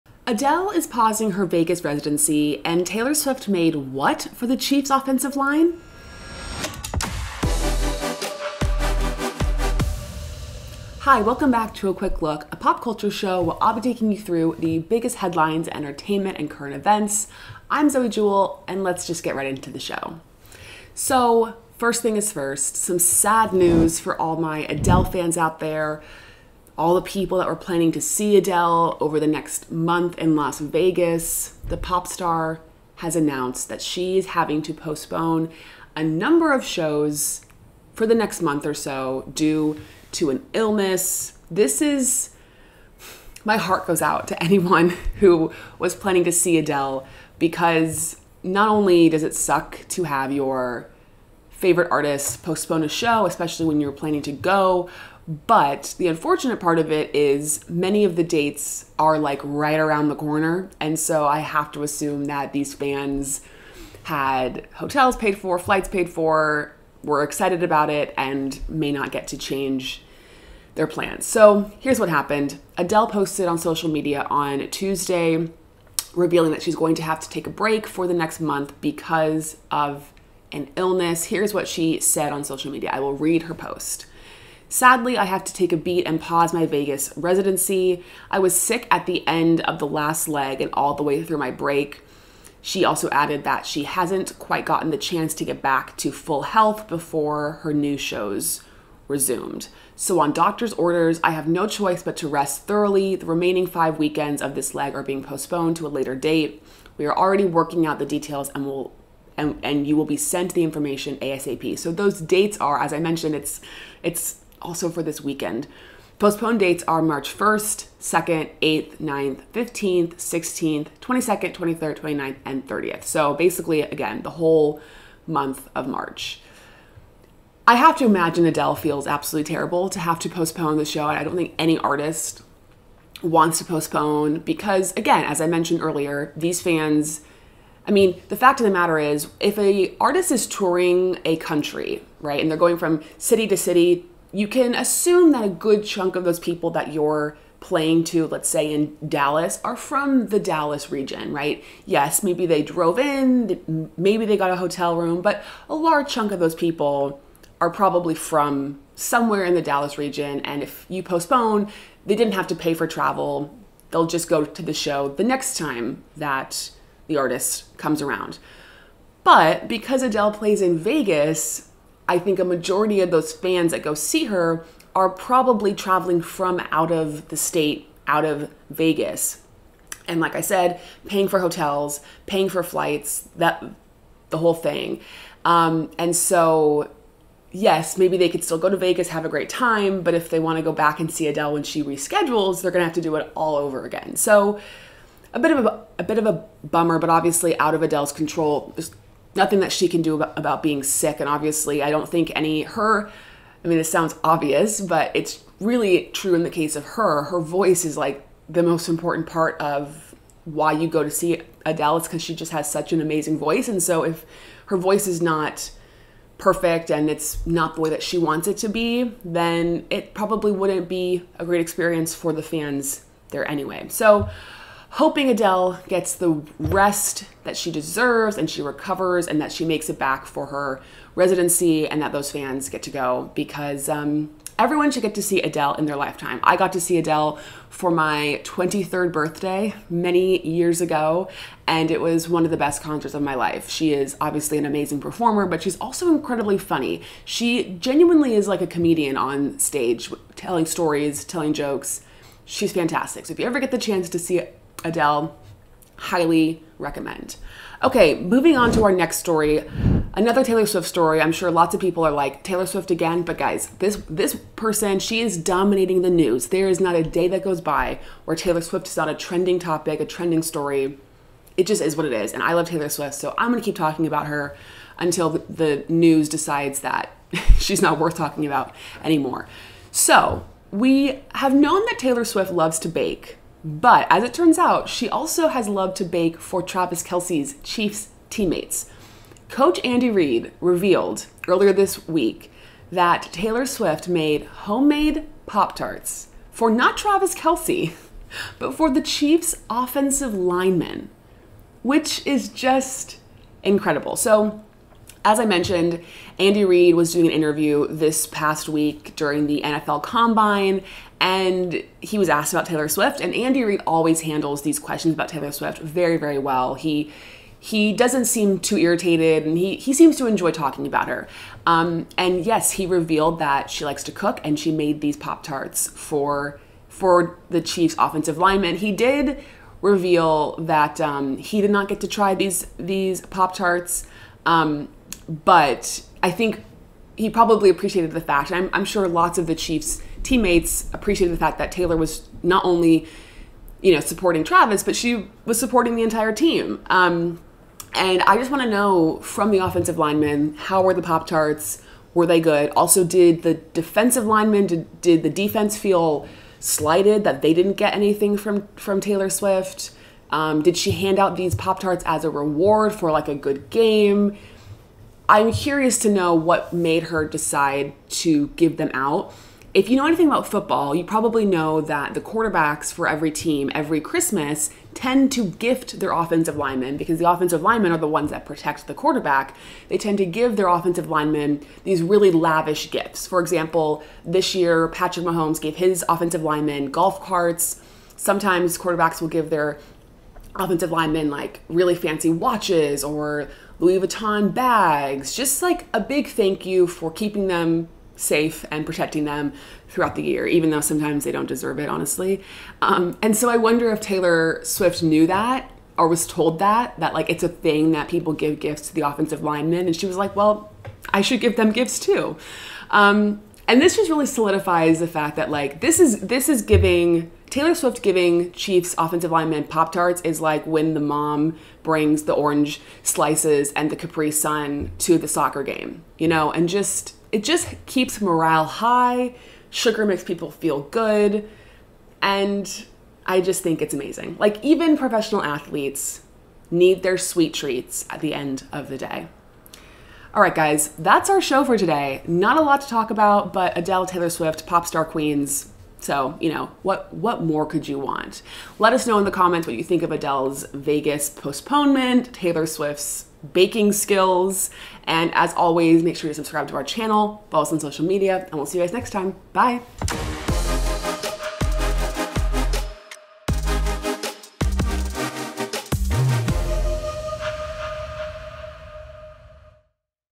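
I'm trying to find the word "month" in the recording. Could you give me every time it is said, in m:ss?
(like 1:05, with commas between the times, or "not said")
0:29, 0:38, 1:18, 2:05.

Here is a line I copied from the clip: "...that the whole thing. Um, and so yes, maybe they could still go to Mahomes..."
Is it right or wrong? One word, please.
wrong.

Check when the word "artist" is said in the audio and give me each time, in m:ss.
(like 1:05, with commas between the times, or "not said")
0:51, 2:11, 2:19, 2:47.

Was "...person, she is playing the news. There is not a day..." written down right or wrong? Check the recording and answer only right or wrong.
wrong.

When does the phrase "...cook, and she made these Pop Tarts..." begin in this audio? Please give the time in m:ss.
5:24.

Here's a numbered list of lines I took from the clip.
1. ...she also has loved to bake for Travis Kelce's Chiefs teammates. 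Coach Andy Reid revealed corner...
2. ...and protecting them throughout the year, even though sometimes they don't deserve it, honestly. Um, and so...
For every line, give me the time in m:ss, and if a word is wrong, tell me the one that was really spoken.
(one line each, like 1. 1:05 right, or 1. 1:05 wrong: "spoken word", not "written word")
1. 4:44 wrong: "earlier", not "corner"
2. 6:38 right.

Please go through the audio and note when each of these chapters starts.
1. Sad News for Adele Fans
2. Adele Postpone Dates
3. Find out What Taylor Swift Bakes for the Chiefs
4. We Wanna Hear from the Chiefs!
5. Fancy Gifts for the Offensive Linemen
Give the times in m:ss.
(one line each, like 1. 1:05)
1. 0:25
2. 1:56
3. 4:20
4. 5:48
5. 6:25.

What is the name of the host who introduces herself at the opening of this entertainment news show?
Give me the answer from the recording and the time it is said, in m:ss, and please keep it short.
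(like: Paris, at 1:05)
Zoe Jewell, at 0:17.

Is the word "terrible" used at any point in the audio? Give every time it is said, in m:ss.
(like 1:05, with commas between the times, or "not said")
2:09.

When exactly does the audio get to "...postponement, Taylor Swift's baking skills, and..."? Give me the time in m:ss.
7:31.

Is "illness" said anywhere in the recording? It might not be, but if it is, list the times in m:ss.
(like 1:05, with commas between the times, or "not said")
0:40, 1:20.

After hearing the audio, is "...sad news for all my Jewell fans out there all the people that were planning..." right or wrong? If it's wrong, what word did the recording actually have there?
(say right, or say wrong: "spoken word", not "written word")
wrong: "Adele", not "Jewell".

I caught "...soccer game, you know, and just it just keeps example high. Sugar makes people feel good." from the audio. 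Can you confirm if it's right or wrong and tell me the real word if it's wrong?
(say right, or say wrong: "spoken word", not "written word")
wrong: "morale", not "example".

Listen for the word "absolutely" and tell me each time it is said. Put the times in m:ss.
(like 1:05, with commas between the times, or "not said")
2:09.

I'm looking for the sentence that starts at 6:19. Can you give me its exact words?
They tend to give their offensive linemen these really lavish gifts.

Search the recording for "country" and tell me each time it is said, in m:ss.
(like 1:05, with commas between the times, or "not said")
2:21.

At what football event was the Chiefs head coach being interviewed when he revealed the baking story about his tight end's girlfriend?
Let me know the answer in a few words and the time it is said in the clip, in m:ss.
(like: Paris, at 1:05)
NFL Combine, at 5:09.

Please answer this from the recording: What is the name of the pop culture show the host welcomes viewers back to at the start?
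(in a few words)
A Quick Look.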